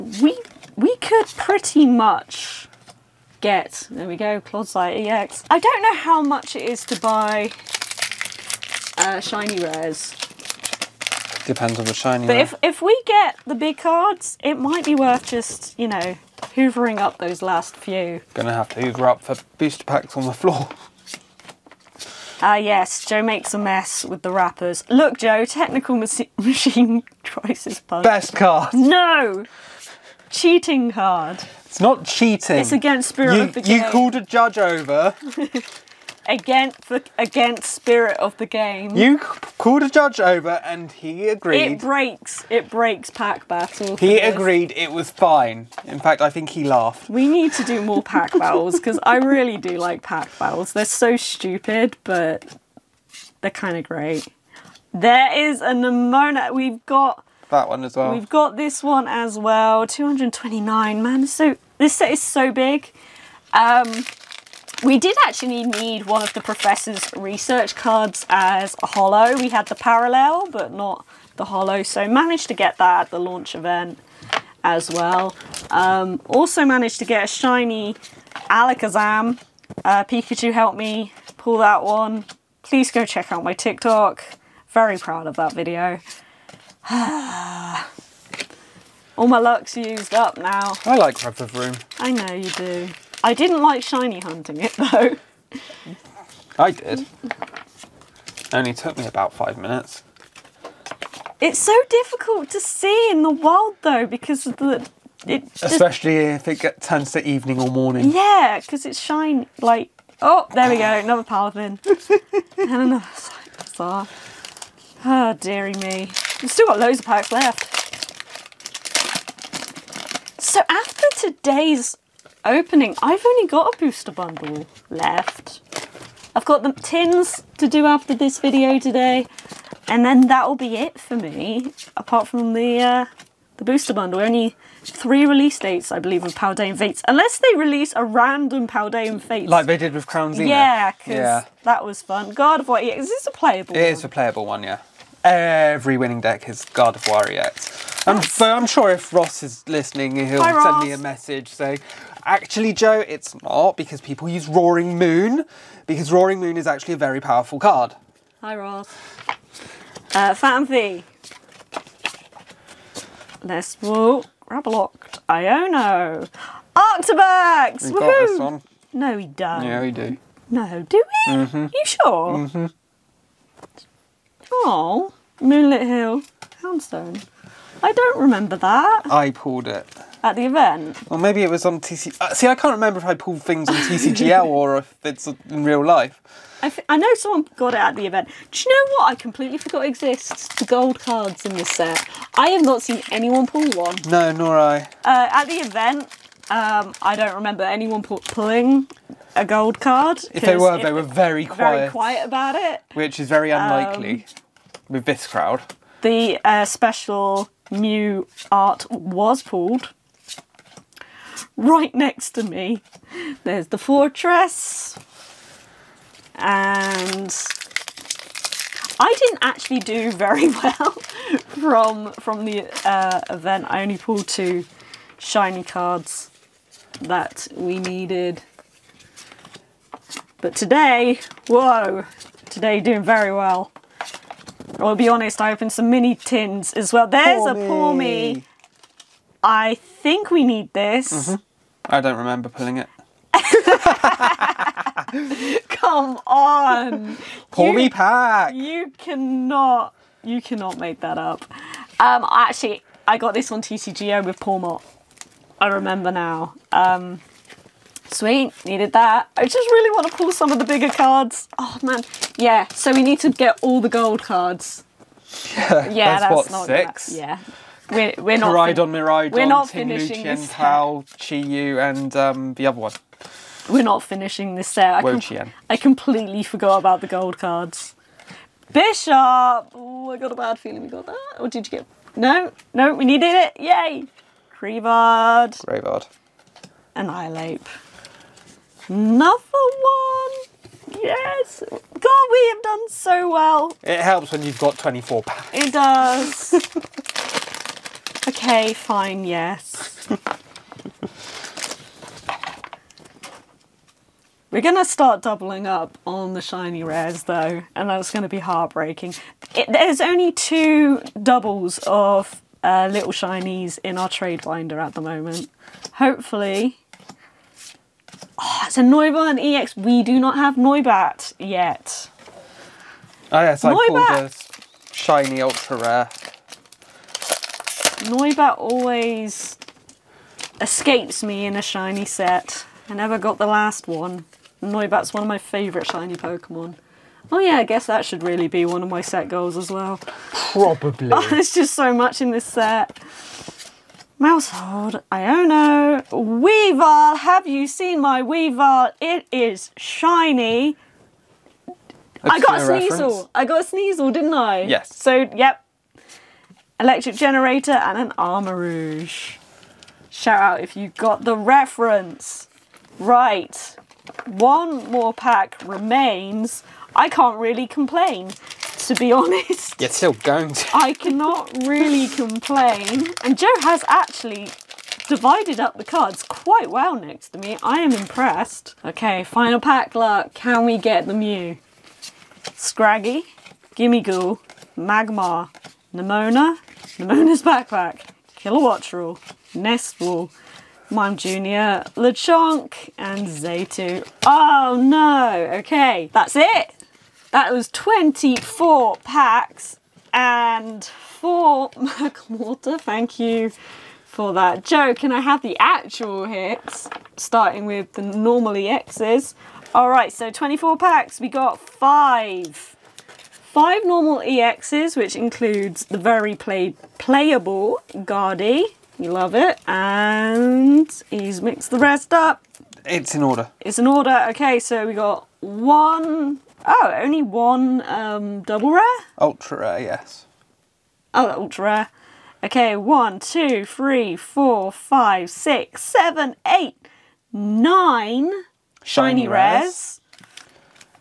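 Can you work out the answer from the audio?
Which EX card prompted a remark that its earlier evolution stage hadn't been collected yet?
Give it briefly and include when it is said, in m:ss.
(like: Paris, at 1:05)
Noivern EX, at 5:18.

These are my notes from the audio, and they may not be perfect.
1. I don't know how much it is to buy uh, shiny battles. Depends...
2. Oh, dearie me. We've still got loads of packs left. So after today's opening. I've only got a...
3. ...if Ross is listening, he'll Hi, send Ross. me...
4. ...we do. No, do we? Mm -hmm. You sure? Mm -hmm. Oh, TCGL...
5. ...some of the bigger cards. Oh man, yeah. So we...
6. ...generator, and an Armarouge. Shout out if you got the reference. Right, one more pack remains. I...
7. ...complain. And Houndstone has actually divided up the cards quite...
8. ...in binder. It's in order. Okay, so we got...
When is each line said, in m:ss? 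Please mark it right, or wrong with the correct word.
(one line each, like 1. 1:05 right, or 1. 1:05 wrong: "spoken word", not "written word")
1. 0:05 wrong: "rares", not "battles"
2. 1:55 right
3. 2:28 right
4. 2:49 wrong: "Moonlit", not "TCGL"
5. 4:20 right
6. 5:57 right
7. 6:12 wrong: "Joe", not "Houndstone"
8. 7:03 wrong: "order", not "binder".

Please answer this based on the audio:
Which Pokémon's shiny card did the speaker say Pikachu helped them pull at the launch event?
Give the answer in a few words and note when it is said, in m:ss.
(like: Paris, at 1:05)
Alakazam, at 1:17.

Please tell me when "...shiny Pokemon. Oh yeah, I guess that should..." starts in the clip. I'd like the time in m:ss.
5:35.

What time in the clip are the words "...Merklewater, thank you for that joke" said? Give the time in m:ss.
6:41.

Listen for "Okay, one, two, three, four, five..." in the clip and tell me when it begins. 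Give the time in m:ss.
7:12.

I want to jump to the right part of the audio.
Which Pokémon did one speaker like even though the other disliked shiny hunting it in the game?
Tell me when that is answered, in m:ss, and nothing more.
1:31.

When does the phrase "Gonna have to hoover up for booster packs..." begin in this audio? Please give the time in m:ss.
0:18.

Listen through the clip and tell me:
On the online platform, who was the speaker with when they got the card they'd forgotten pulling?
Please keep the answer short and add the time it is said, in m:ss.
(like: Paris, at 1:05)
Paul Mott, at 4:14.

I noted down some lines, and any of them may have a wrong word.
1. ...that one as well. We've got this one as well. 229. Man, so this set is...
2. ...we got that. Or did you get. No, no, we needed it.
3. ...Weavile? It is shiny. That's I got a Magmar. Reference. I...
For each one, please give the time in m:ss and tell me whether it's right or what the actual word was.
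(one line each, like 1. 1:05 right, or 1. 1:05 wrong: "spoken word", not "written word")
1. 0:57 right
2. 4:40 right
3. 5:48 wrong: "Sneasel", not "Magmar".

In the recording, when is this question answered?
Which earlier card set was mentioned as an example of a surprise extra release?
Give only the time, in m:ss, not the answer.
2:20.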